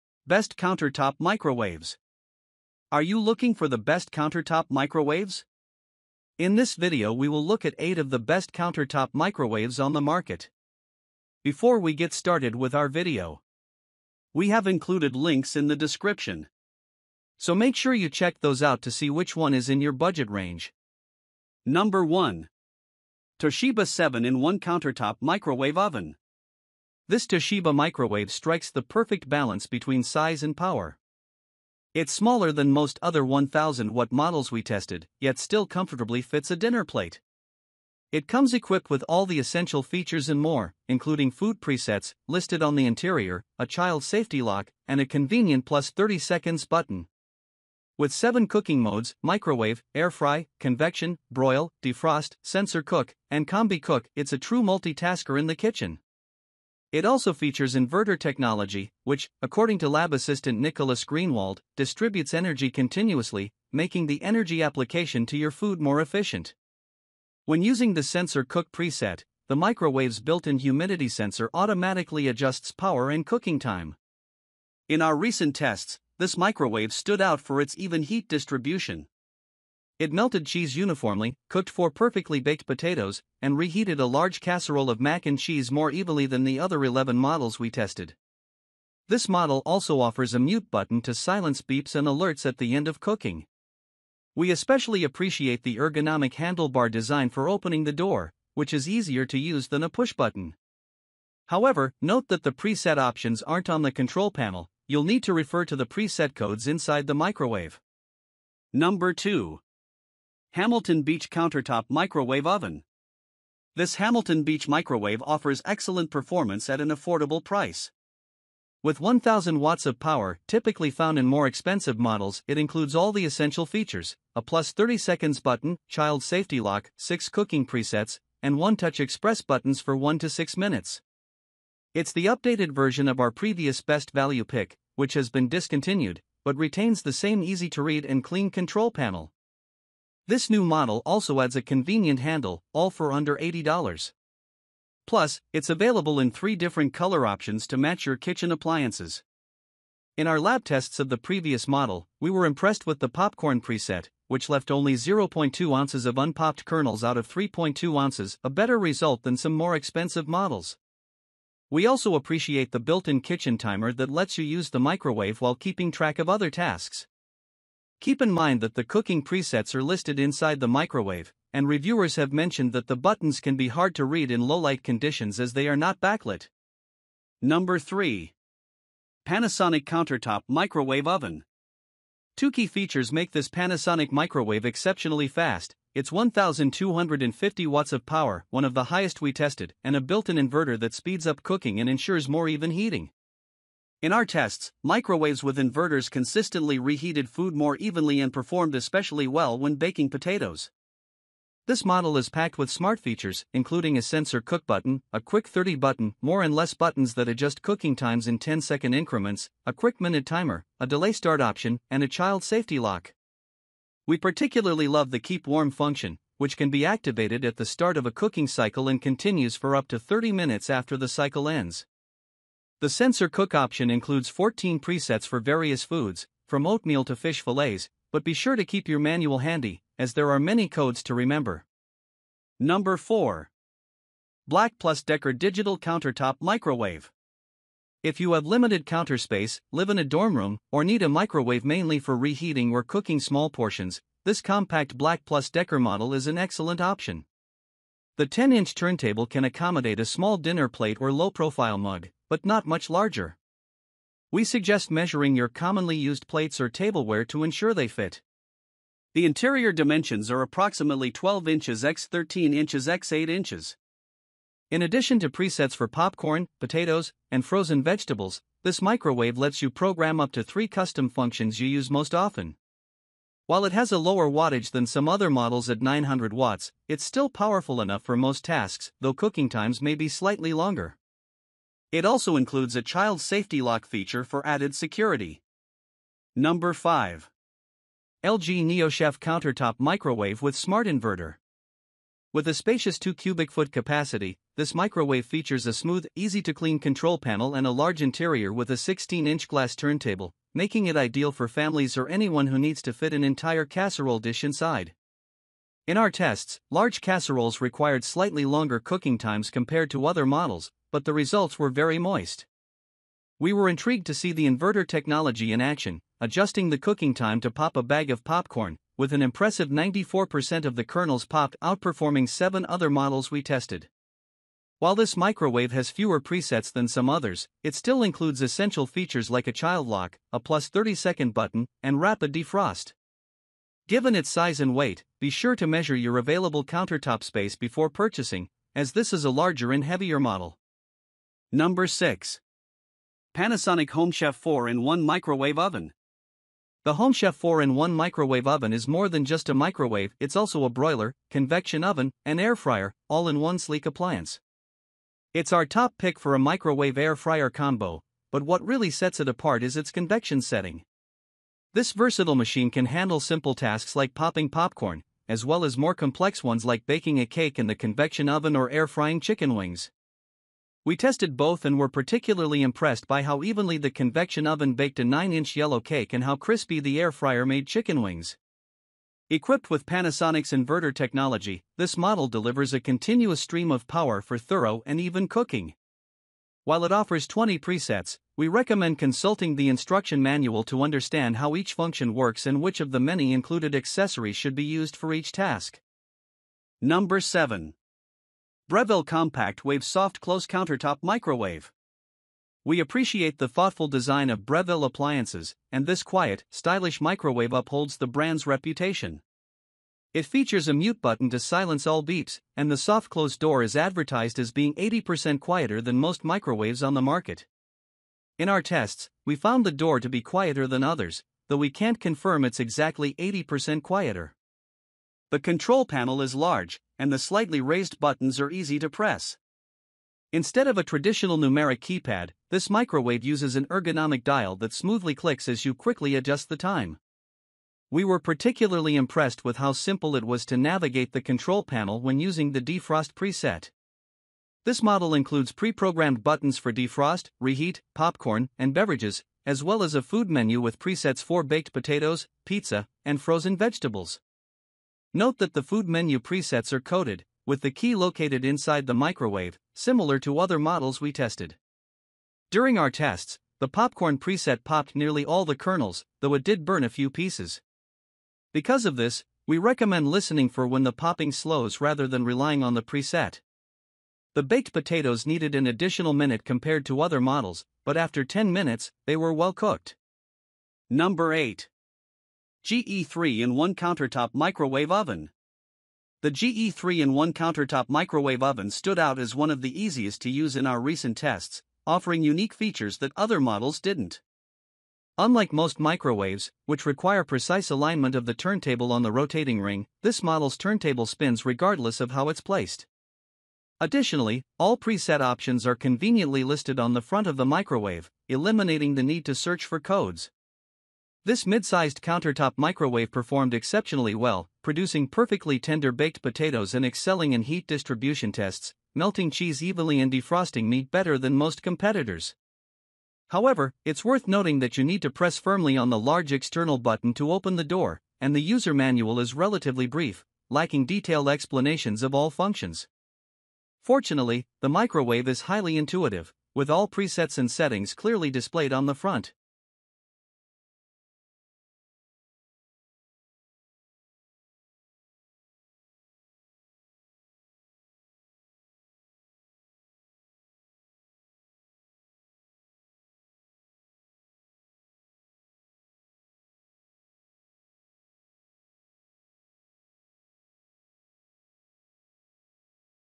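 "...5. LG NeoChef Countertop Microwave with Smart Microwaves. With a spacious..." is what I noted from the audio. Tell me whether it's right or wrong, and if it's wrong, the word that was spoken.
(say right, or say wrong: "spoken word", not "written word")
wrong: "Inverter", not "Microwaves".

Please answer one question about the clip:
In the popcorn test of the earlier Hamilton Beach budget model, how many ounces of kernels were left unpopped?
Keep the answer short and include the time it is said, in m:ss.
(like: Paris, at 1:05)
0.2 ounces, at 2:34.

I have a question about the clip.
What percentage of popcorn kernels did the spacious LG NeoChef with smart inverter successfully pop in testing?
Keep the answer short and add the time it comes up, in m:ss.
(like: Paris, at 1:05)
94%, at 5:19.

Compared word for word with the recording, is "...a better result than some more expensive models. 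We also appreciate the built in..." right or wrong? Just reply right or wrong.
right.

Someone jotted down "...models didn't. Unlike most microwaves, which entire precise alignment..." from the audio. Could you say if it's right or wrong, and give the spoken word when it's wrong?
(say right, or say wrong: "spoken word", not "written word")
wrong: "require", not "entire".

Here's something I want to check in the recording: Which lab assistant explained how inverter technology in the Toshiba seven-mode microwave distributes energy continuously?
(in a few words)
Nicholas Greenwald.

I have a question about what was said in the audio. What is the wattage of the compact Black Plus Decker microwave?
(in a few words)
900 watts.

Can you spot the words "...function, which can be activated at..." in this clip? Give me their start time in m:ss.
3:35.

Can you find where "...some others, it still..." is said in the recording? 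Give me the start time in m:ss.
5:26.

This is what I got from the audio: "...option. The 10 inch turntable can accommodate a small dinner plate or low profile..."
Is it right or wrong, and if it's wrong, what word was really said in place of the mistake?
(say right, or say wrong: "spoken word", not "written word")
right.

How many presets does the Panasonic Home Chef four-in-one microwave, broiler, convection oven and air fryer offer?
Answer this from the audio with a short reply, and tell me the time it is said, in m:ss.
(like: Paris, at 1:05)
20, at 6:27.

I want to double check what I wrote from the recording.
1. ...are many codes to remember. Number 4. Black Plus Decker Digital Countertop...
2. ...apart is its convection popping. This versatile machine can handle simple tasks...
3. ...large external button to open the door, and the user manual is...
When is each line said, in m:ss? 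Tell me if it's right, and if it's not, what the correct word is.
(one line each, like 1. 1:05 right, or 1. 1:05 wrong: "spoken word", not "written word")
1. 3:50 right
2. 5:59 wrong: "setting", not "popping"
3. 8:45 right.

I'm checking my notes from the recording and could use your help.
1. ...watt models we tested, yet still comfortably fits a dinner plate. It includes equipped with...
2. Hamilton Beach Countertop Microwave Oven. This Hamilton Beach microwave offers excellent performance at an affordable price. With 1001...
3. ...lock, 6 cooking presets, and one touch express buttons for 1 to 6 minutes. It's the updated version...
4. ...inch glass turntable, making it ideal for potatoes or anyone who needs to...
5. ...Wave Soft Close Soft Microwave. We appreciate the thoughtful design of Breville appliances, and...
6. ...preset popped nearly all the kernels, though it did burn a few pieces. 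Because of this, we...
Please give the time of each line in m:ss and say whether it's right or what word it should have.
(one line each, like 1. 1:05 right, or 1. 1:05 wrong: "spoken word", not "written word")
1. 0:33 wrong: "comes", not "includes"
2. 1:50 wrong: "1000", not "1001"
3. 2:06 right
4. 4:59 wrong: "families", not "potatoes"
5. 6:39 wrong: "Countertop", not "Soft"
6. 7:44 right.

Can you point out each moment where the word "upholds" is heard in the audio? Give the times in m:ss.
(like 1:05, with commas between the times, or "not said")
6:47.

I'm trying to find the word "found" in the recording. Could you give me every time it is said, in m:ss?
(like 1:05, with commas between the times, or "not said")
2:00, 6:59.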